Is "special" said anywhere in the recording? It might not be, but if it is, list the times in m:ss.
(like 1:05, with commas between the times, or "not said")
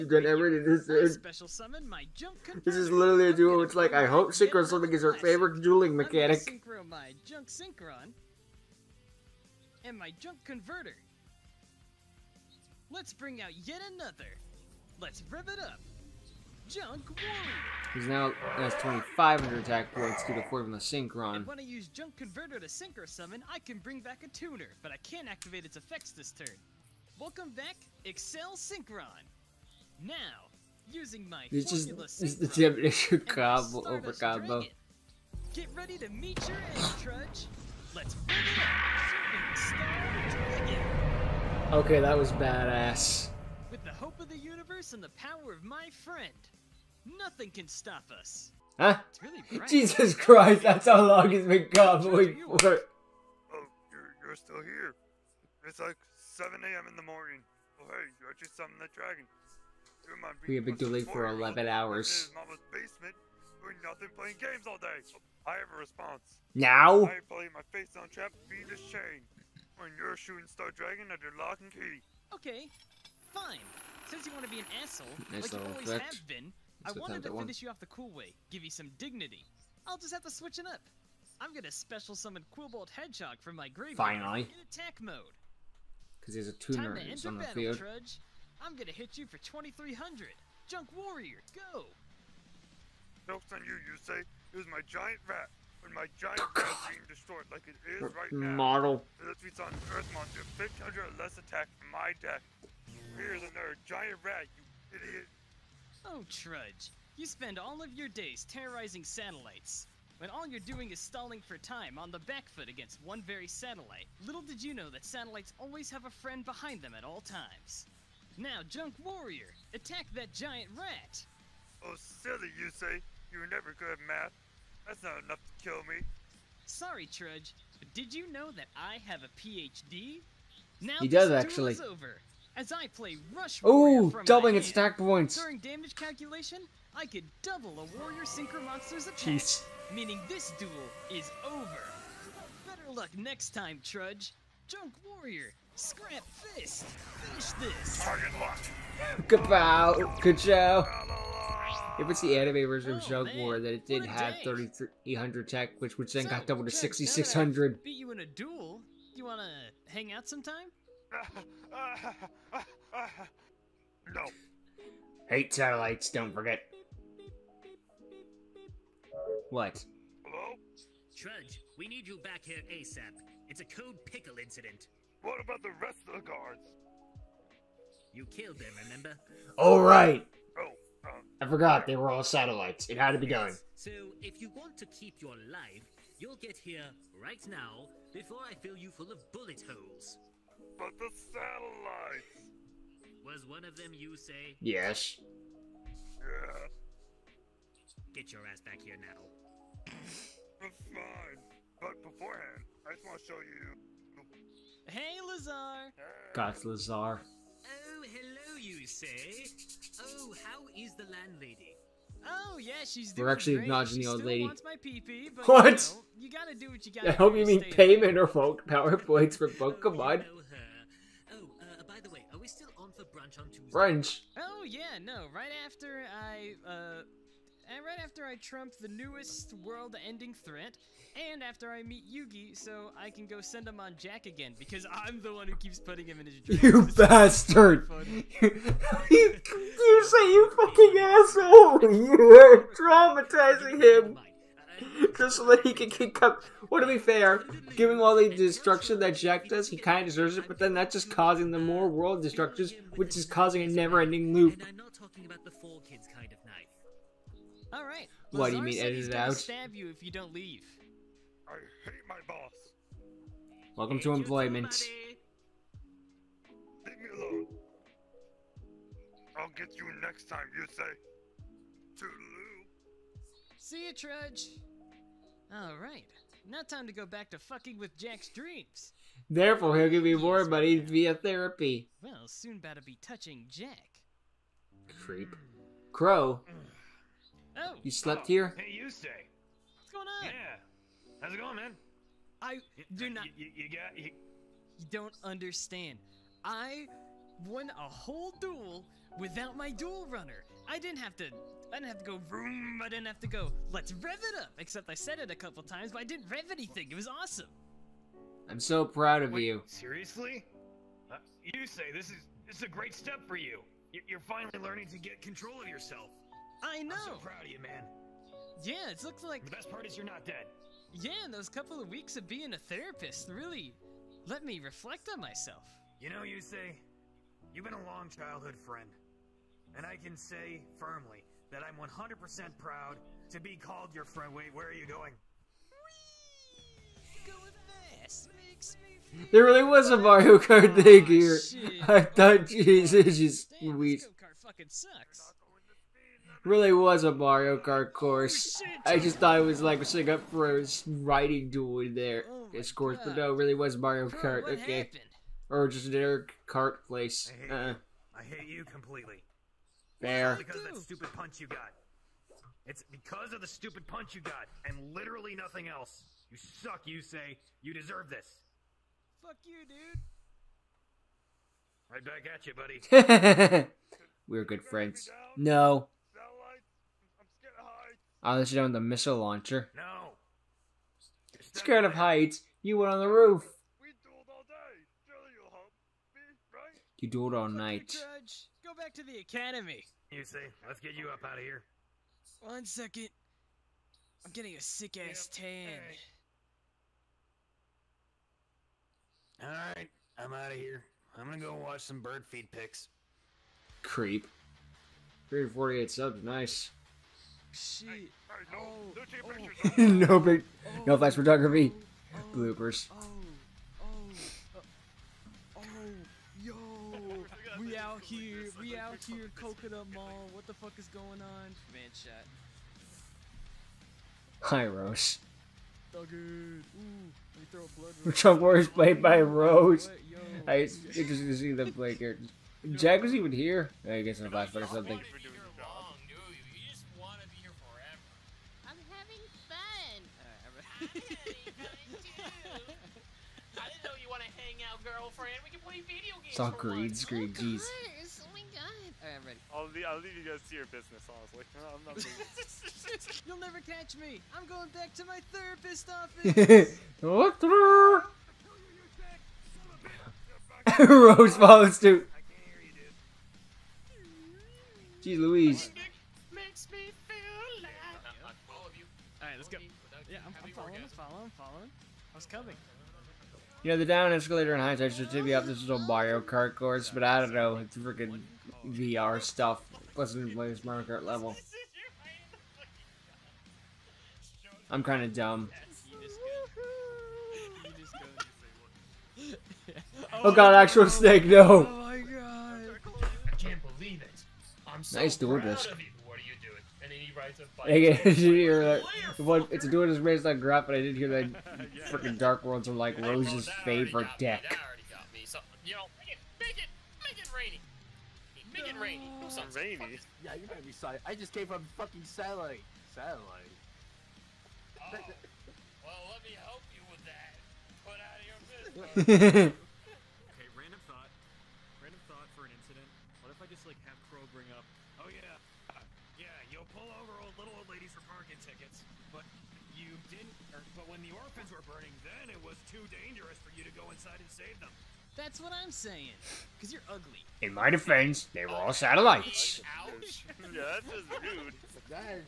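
0:01, 1:21.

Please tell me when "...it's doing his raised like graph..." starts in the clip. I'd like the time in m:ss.
8:19.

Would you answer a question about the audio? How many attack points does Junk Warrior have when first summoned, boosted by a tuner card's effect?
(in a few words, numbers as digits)
2500.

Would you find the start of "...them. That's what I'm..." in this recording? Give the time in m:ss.
8:54.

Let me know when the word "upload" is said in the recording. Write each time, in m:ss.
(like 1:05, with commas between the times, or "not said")
not said.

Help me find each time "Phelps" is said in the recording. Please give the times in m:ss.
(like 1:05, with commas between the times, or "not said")
not said.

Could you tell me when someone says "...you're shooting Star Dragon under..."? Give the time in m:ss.
1:09.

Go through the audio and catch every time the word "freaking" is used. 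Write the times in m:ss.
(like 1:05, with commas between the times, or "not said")
7:57, 8:21.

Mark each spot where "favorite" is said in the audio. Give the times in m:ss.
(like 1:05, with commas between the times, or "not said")
0:05, 8:23.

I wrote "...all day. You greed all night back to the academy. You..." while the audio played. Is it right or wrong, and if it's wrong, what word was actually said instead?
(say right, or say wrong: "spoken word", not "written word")
wrong: "dueled", not "greed".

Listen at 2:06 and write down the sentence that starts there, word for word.
Sorry, Trudge, but did you know that I have a PhD?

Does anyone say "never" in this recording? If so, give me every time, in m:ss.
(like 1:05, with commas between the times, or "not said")
2:03, 4:13, 7:33.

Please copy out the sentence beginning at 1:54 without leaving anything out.
Little did you know that satellites always have a friend behind them at all times.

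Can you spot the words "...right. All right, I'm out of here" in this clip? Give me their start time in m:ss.
6:39.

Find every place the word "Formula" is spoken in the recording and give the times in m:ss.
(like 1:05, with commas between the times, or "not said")
0:20, 0:31.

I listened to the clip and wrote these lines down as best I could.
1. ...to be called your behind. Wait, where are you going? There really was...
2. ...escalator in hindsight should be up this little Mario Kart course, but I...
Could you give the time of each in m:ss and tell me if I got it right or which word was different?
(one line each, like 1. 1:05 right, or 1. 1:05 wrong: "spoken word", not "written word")
1. 5:33 wrong: "friend", not "behind"
2. 7:54 right.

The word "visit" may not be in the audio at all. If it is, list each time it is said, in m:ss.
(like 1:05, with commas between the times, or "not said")
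not said.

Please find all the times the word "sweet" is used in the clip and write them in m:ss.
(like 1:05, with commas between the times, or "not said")
5:43.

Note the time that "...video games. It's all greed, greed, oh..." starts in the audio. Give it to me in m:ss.
7:25.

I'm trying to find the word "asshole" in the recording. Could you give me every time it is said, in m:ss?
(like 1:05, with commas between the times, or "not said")
1:14, 4:00.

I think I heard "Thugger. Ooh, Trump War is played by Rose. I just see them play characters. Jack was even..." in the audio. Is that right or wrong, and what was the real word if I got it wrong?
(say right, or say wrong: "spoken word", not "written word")
right.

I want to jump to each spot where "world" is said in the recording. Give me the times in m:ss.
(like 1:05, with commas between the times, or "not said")
3:49, 4:11, 8:22.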